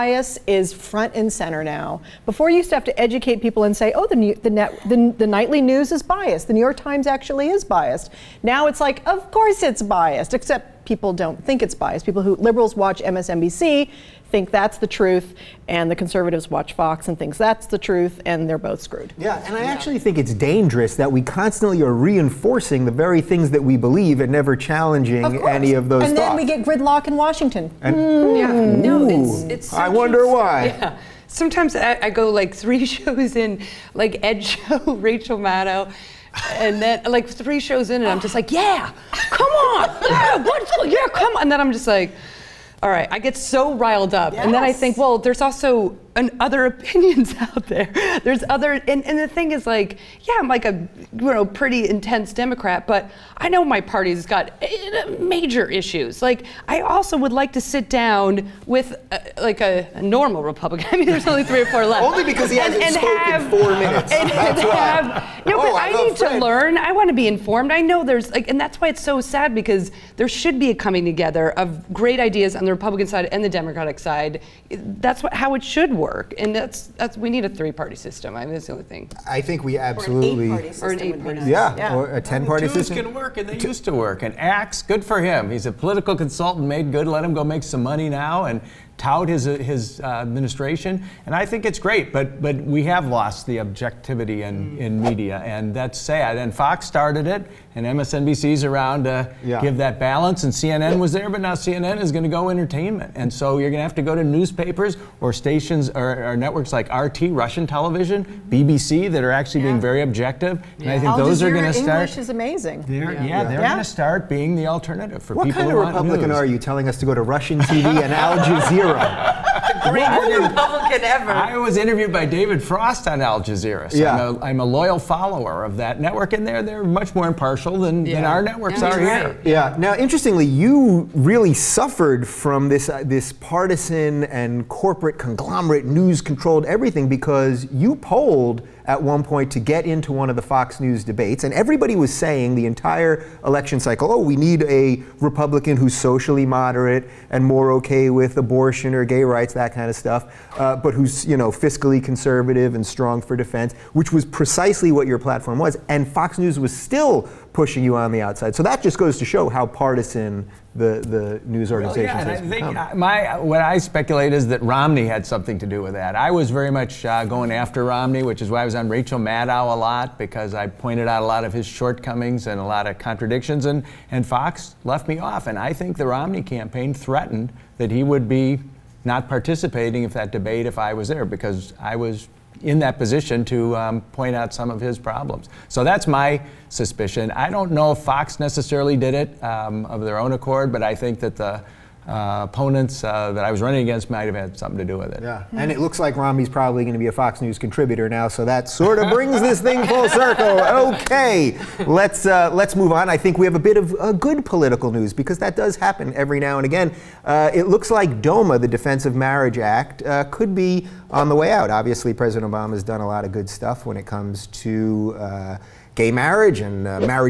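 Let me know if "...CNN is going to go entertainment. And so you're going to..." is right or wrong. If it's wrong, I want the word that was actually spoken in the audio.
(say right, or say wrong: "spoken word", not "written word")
right.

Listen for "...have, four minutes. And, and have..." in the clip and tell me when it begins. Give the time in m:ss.
1:03.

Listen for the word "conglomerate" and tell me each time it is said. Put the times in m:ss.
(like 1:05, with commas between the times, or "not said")
2:15.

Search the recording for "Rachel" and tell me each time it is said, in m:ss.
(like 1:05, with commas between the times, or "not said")
0:34, 2:48.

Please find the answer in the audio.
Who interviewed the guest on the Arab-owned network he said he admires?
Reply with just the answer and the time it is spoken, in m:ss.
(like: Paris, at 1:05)
David Frost, at 2:02.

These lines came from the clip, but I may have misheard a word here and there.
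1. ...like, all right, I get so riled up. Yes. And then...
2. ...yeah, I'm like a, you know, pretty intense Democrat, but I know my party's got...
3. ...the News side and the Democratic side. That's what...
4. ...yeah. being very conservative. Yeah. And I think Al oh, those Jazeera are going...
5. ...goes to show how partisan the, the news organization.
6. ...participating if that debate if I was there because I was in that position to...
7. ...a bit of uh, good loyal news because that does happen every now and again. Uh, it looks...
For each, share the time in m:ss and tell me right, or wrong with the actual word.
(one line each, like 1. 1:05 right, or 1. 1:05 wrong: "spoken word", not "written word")
1. 0:41 right
2. 0:50 right
3. 1:12 wrong: "Republican", not "News"
4. 1:49 wrong: "objective", not "conservative"
5. 2:38 right
6. 2:59 right
7. 3:23 wrong: "political", not "loyal".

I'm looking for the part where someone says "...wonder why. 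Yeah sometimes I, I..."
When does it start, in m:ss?
0:29.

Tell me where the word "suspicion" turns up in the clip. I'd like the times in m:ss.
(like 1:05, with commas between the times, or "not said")
3:06.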